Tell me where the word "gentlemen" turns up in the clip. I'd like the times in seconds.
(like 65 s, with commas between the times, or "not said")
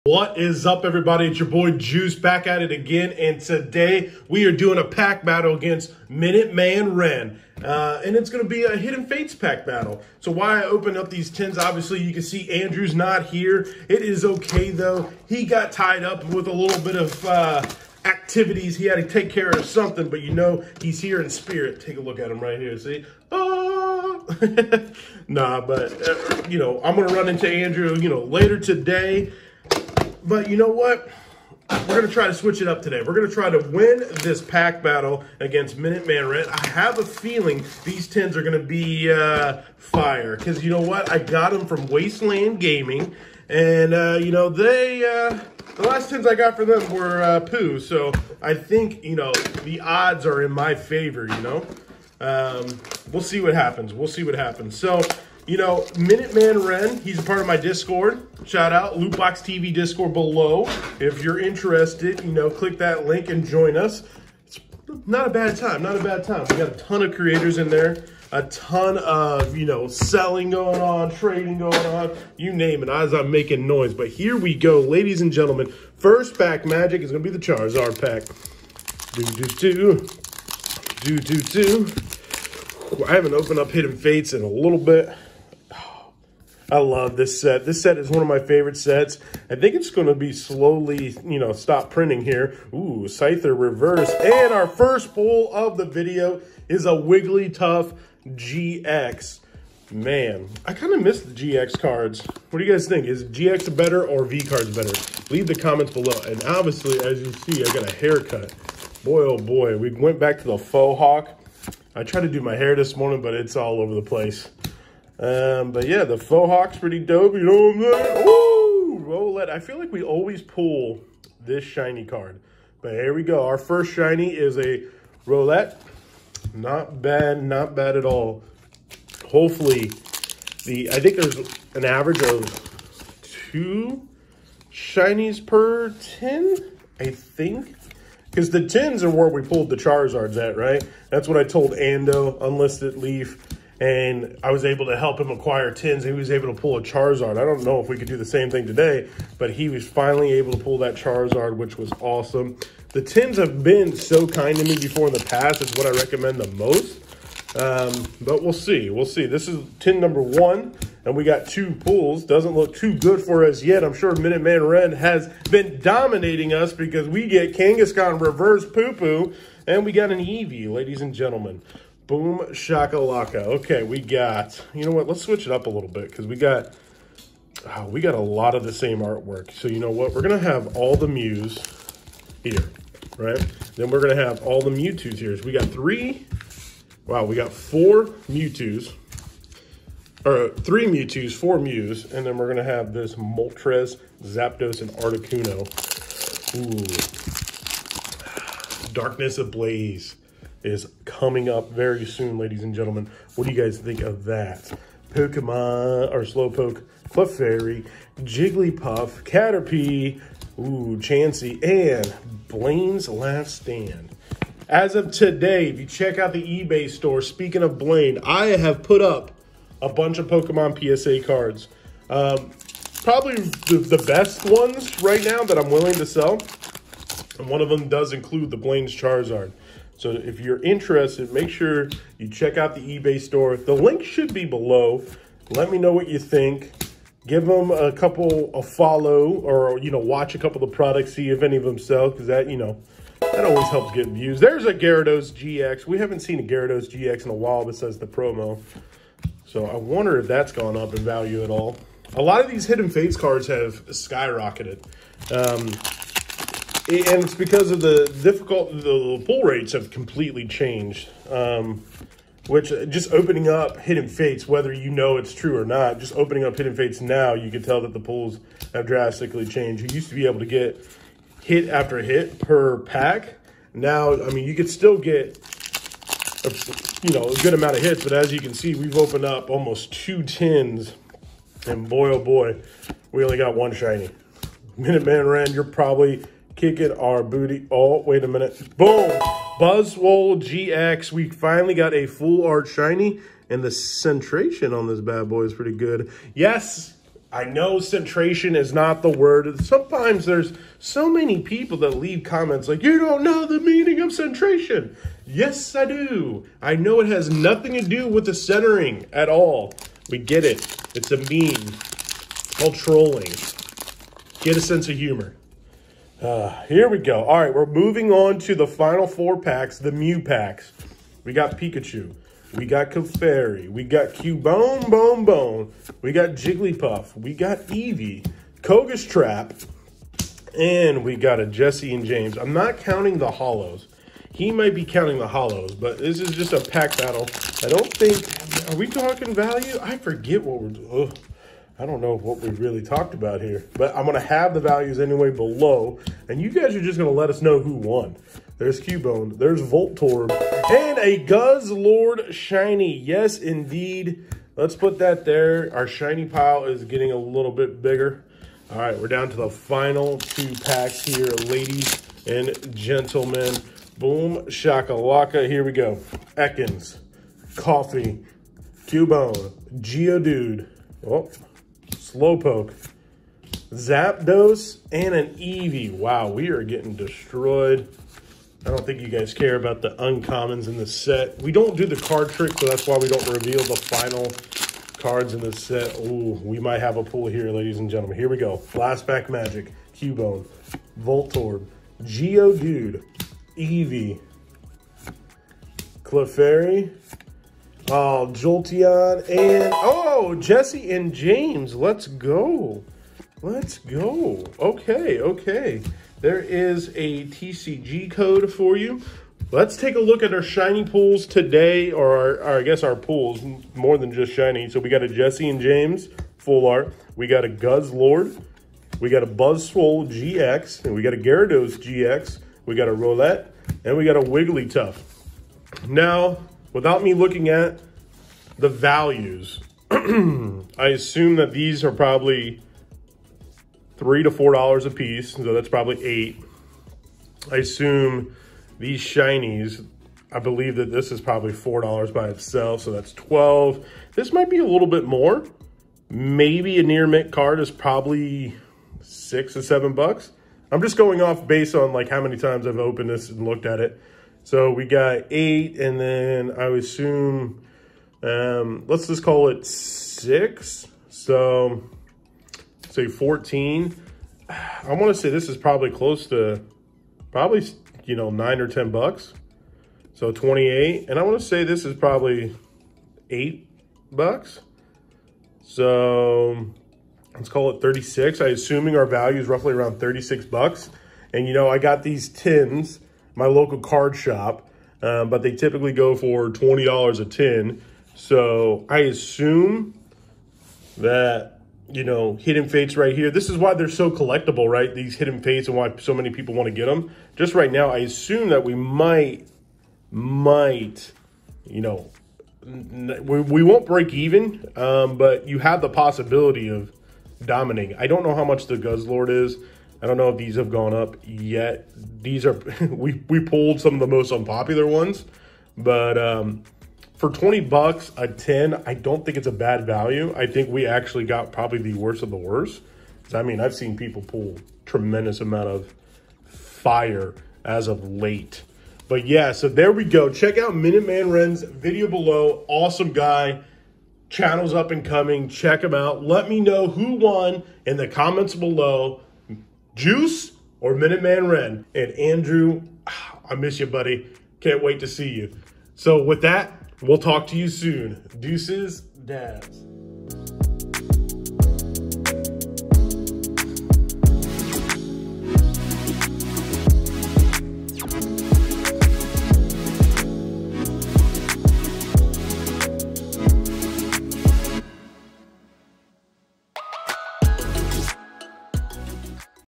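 75 s, 171 s, 202 s, 362 s, 387 s.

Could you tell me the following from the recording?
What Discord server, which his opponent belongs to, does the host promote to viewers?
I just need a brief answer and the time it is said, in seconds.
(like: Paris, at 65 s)
Lootbox TV, at 58 s.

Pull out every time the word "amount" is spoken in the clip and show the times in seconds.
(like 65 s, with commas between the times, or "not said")
277 s, 525 s.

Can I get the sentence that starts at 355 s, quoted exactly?
Our Shiny pile is getting a little bit bigger.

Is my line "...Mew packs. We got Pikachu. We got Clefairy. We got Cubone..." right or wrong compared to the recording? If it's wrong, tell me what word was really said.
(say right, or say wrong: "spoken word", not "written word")
right.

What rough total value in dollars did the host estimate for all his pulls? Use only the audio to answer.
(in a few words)
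$36.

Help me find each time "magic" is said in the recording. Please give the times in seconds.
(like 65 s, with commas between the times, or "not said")
76 s, 389 s.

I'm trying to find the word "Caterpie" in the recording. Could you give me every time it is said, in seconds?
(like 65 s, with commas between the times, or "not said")
209 s.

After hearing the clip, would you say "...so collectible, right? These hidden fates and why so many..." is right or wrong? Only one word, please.
right.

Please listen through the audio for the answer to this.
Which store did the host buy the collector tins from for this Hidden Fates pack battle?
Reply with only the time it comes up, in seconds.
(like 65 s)
41 s.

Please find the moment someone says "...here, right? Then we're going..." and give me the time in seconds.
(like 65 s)
182 s.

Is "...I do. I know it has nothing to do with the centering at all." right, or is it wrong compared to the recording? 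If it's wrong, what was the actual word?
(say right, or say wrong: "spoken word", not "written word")
right.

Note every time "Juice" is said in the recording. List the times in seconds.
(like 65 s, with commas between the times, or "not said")
1 s, 539 s.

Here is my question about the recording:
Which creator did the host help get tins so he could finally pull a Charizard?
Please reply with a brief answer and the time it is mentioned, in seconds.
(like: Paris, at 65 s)
Unlisted Leaf, at 142 s.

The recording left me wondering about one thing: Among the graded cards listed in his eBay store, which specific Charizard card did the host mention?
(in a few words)
Blaine's Charizard.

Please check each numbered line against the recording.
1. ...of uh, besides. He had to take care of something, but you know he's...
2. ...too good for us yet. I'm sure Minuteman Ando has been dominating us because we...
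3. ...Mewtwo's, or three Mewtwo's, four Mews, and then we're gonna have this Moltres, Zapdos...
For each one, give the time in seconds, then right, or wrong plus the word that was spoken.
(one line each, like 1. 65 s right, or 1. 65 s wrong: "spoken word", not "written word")
1. 16 s wrong: "activities", not "besides"
2. 162 s wrong: "Ren", not "Ando"
3. 188 s right.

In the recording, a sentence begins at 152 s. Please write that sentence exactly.
The 10s have been so kind to me before in the past.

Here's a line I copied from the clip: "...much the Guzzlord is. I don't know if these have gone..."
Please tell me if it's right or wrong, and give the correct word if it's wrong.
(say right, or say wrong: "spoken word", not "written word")
right.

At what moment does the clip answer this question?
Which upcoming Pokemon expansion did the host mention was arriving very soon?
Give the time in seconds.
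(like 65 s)
198 s.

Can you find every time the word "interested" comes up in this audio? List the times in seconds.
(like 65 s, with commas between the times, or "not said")
61 s, 230 s.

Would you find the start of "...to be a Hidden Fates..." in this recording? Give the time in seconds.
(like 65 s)
8 s.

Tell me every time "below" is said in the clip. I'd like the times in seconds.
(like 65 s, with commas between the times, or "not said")
60 s, 105 s, 234 s, 345 s, 532 s, 538 s.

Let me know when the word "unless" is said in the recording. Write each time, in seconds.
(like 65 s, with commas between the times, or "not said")
not said.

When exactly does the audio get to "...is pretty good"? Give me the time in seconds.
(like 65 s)
295 s.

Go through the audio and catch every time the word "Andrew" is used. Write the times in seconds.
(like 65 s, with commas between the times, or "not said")
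12 s, 27 s, 542 s.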